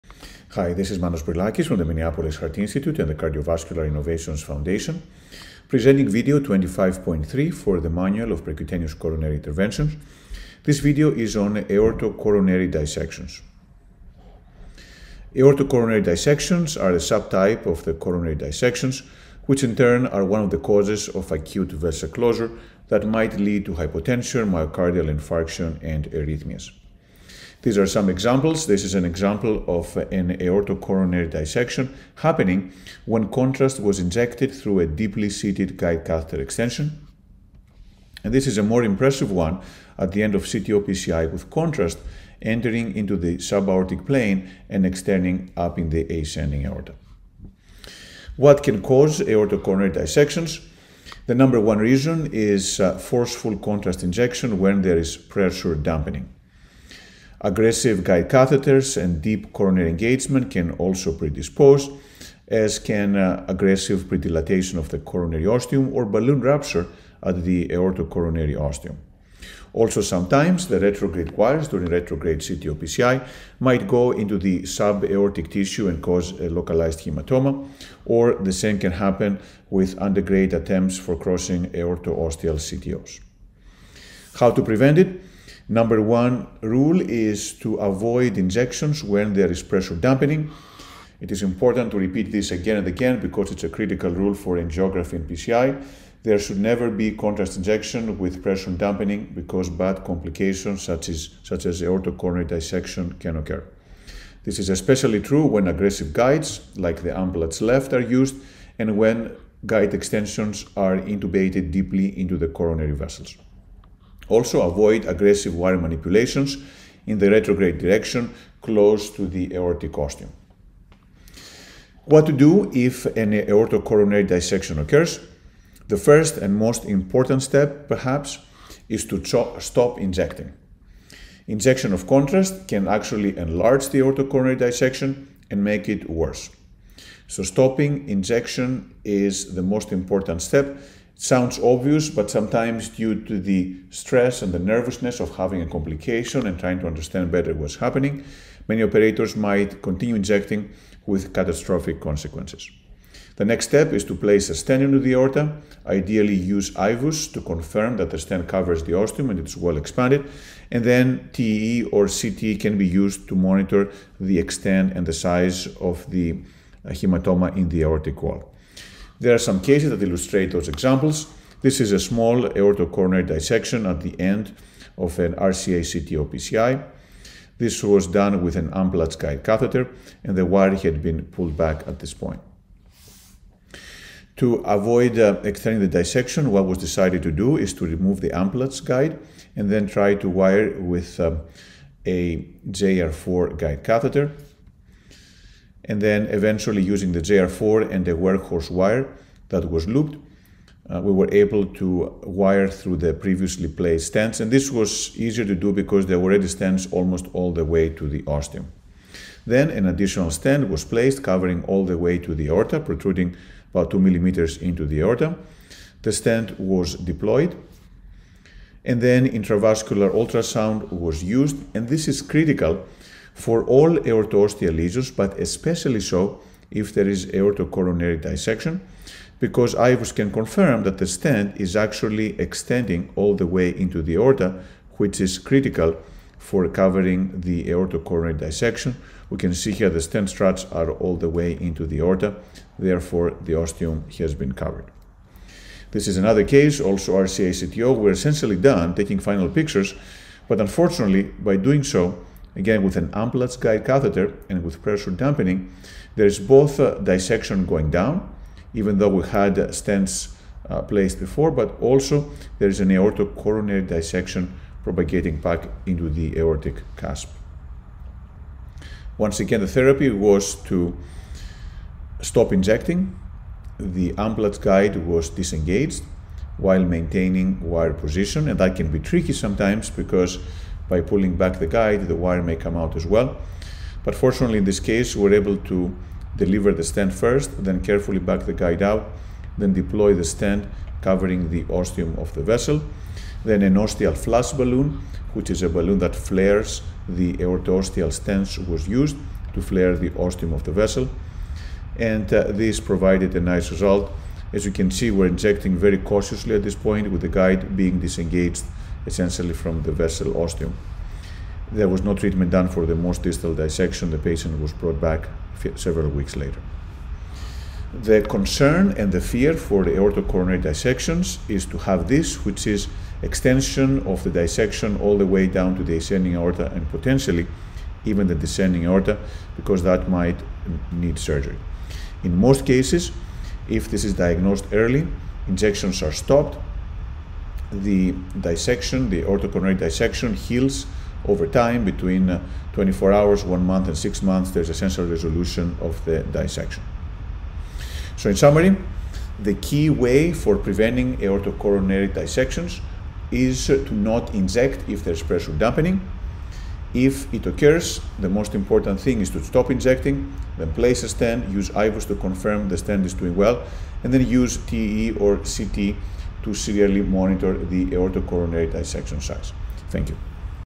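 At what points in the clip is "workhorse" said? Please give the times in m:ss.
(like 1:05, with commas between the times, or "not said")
3:18.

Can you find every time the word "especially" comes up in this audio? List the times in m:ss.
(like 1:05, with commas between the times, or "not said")
1:44, 3:45.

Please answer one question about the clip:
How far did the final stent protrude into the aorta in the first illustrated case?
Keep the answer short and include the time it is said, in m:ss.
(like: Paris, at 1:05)
2 millimeters, at 3:33.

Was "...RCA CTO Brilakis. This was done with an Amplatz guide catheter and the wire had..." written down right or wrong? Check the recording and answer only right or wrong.
wrong.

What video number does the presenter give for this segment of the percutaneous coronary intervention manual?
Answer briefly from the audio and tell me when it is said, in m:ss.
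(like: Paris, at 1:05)
25.3, at 0:06.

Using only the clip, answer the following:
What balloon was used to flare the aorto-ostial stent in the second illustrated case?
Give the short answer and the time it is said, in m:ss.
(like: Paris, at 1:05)
ostial flash balloon, at 4:53.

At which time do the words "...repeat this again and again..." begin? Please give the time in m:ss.
1:31.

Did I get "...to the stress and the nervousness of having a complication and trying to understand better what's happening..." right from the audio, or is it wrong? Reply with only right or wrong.
right.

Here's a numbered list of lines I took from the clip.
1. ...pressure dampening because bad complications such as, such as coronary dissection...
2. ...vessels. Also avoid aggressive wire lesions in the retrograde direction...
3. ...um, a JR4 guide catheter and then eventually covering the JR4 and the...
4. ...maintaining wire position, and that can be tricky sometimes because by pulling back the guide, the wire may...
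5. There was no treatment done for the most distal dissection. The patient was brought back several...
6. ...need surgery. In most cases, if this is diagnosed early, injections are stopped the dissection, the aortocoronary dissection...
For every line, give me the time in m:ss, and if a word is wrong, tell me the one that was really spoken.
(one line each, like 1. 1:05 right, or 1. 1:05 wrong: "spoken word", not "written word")
1. 1:38 right
2. 1:52 wrong: "manipulations", not "lesions"
3. 3:11 wrong: "using", not "covering"
4. 4:36 right
5. 5:11 right
6. 5:30 right.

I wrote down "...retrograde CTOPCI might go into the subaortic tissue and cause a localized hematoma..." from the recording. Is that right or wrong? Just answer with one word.
right.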